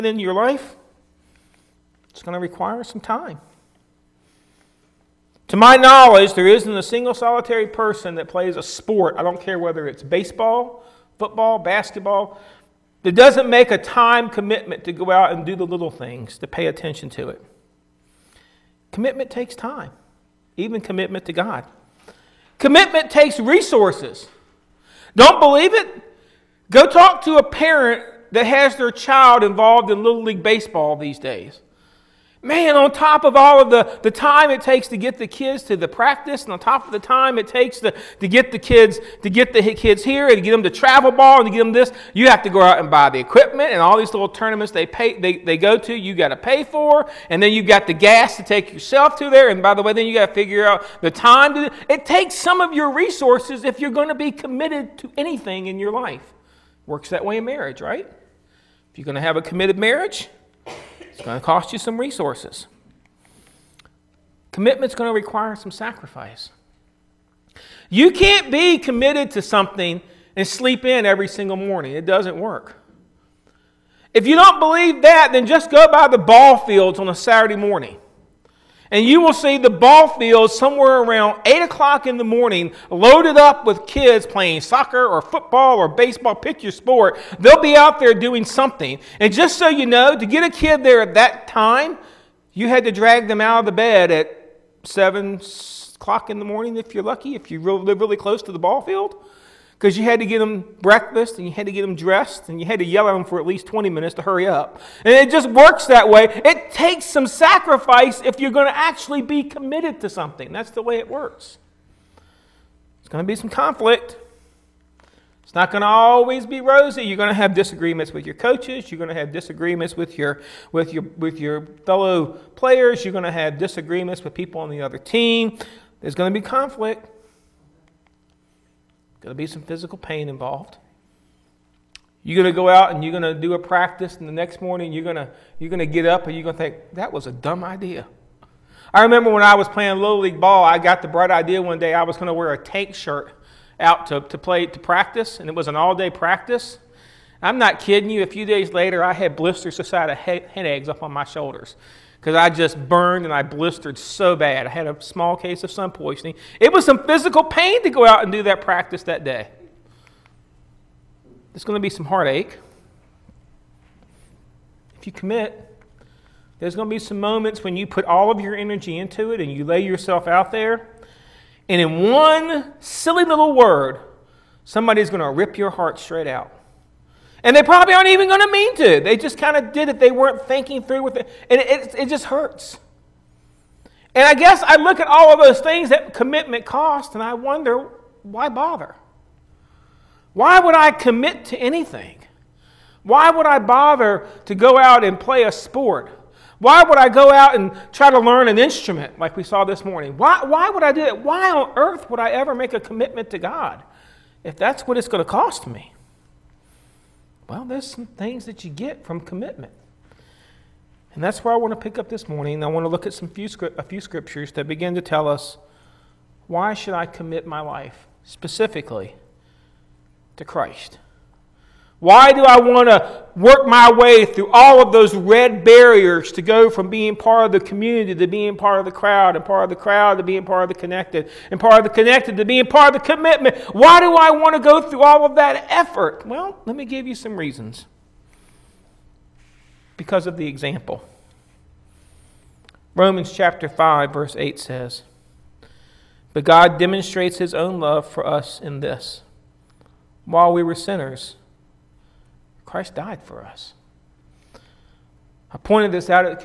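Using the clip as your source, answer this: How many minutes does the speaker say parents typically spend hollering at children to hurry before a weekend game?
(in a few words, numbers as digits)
20 minutes.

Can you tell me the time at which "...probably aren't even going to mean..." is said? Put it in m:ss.
2:57.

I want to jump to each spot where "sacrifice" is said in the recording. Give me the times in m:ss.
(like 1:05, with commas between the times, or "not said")
1:05, 1:47.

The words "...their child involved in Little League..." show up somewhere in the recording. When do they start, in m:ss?
0:28.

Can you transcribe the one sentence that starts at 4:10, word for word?
While we were sinners, Christ died for us.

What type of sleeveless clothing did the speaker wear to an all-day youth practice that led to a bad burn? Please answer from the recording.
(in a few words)
tank shirt.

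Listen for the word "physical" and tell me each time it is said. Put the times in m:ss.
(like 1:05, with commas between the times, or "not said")
2:09, 2:37.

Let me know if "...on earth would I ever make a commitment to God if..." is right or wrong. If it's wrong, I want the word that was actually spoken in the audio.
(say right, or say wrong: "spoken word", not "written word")
right.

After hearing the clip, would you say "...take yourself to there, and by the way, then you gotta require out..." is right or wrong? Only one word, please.
wrong.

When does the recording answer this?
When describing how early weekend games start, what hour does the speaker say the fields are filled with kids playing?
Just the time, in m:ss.
1:21.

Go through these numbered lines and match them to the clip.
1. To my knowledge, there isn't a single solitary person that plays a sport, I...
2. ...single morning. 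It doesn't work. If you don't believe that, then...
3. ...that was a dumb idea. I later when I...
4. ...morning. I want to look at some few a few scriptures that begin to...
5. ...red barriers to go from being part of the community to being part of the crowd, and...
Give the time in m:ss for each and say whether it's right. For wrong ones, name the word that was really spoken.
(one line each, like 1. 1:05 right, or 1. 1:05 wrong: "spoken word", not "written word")
1. 0:05 right
2. 1:11 right
3. 2:16 wrong: "remember", not "later"
4. 3:32 right
5. 3:45 right.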